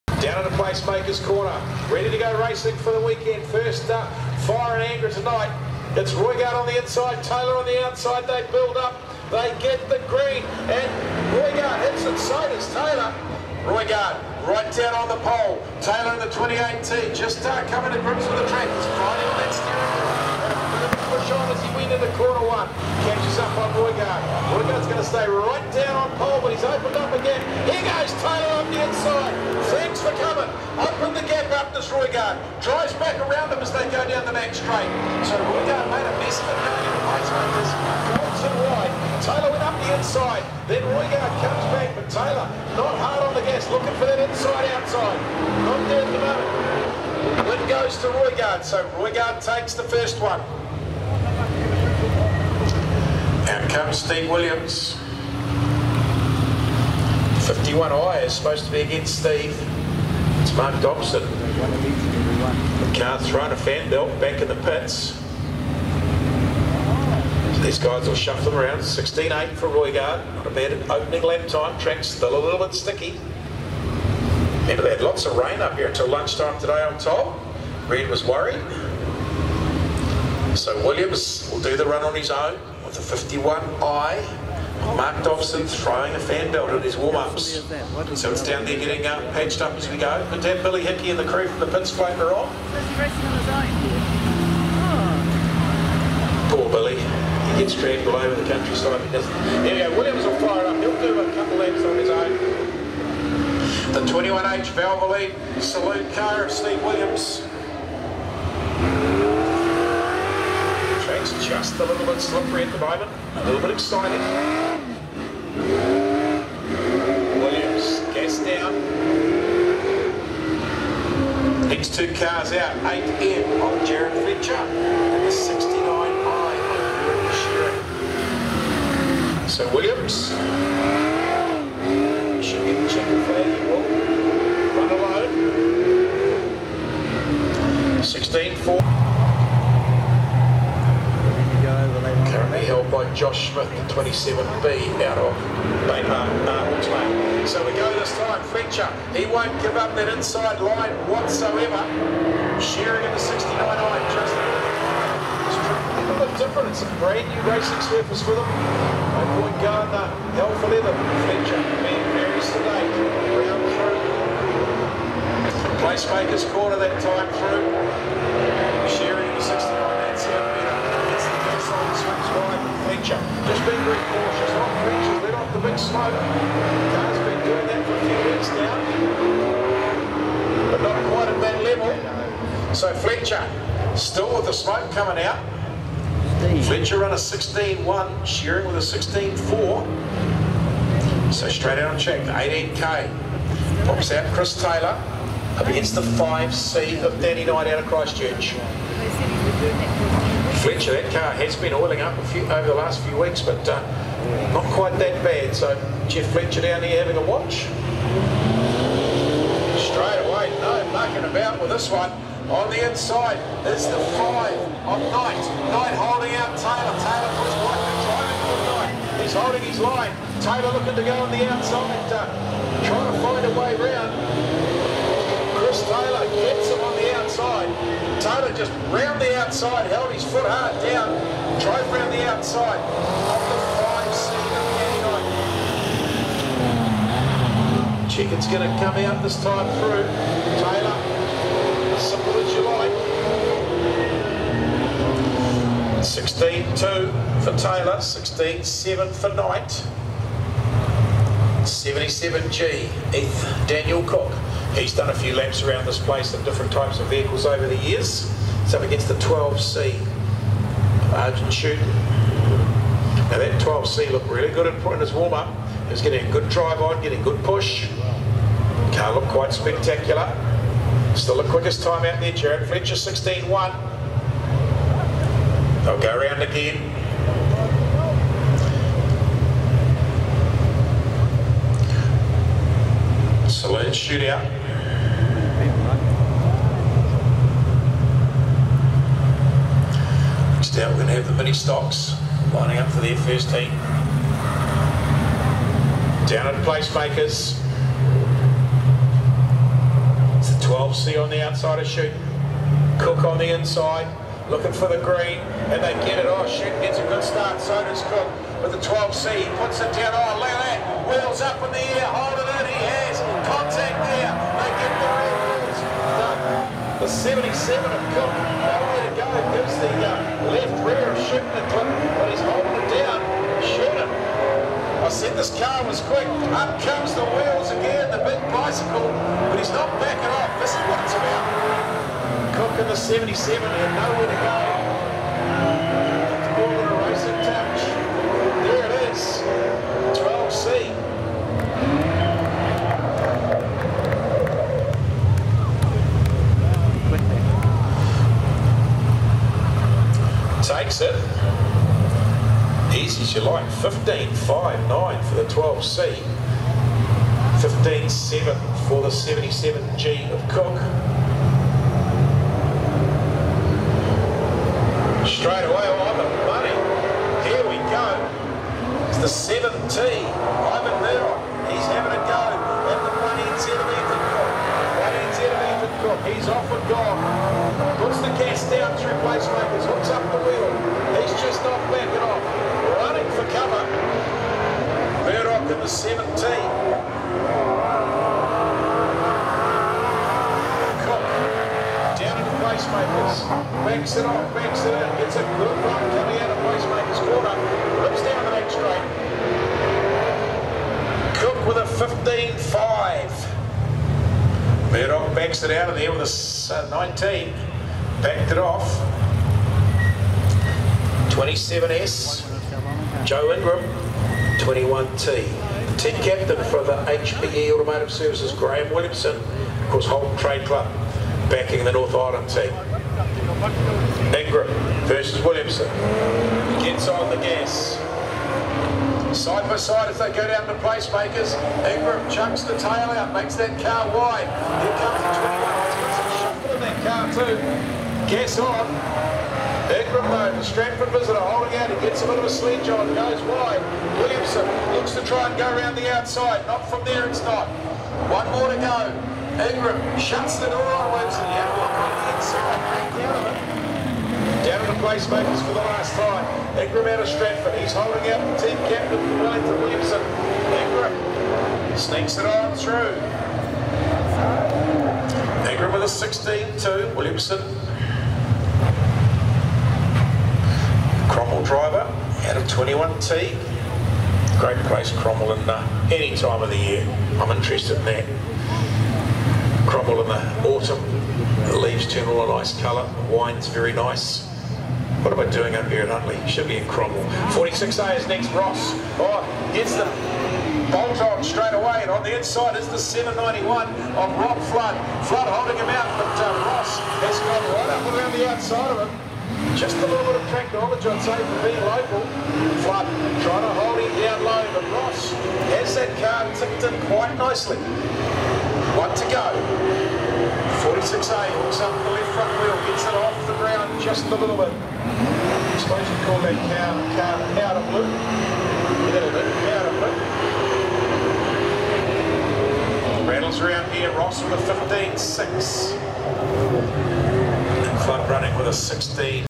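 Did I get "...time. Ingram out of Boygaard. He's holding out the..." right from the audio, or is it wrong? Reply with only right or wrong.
wrong.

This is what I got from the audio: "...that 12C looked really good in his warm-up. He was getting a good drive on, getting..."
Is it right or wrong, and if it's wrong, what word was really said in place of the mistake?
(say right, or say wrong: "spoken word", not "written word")
right.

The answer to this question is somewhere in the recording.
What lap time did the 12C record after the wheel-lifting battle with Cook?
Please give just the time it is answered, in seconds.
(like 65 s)
353 s.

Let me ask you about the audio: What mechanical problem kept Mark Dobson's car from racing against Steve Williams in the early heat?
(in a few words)
Thrown a fan belt.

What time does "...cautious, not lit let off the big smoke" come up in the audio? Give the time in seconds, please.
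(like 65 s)
173 s.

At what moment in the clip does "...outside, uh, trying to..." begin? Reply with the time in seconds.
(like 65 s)
221 s.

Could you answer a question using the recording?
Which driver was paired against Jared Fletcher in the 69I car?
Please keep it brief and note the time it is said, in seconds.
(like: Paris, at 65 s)
Aaron Shearer, at 129 s.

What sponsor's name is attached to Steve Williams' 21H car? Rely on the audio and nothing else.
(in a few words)
Valvoline.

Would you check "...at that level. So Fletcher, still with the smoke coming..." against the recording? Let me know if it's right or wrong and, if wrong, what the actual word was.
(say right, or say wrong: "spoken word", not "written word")
right.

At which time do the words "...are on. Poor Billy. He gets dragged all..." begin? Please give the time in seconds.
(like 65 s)
92 s.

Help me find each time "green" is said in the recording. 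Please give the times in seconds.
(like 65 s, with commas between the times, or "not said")
10 s, 305 s.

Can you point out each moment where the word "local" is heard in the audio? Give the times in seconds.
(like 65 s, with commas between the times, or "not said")
501 s.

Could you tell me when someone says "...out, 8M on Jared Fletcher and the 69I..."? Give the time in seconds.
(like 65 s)
122 s.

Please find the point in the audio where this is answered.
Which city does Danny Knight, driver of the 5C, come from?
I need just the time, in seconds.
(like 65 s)
197 s.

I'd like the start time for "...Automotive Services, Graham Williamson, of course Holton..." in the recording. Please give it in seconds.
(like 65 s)
417 s.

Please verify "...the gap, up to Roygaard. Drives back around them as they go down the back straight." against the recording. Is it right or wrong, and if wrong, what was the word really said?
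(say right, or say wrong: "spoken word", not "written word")
right.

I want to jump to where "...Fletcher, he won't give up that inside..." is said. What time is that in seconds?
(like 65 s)
148 s.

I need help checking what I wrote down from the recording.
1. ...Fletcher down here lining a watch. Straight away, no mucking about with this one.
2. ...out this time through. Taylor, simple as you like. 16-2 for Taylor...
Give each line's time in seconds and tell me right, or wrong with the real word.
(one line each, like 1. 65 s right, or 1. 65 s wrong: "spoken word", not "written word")
1. 206 s wrong: "having", not "lining"
2. 238 s right.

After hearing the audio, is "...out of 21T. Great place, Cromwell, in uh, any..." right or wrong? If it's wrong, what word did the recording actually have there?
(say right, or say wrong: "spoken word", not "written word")
right.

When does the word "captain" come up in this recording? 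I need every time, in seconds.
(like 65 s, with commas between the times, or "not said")
416 s, 458 s.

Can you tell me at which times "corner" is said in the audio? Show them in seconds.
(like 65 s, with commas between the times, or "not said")
1 s, 22 s, 166 s.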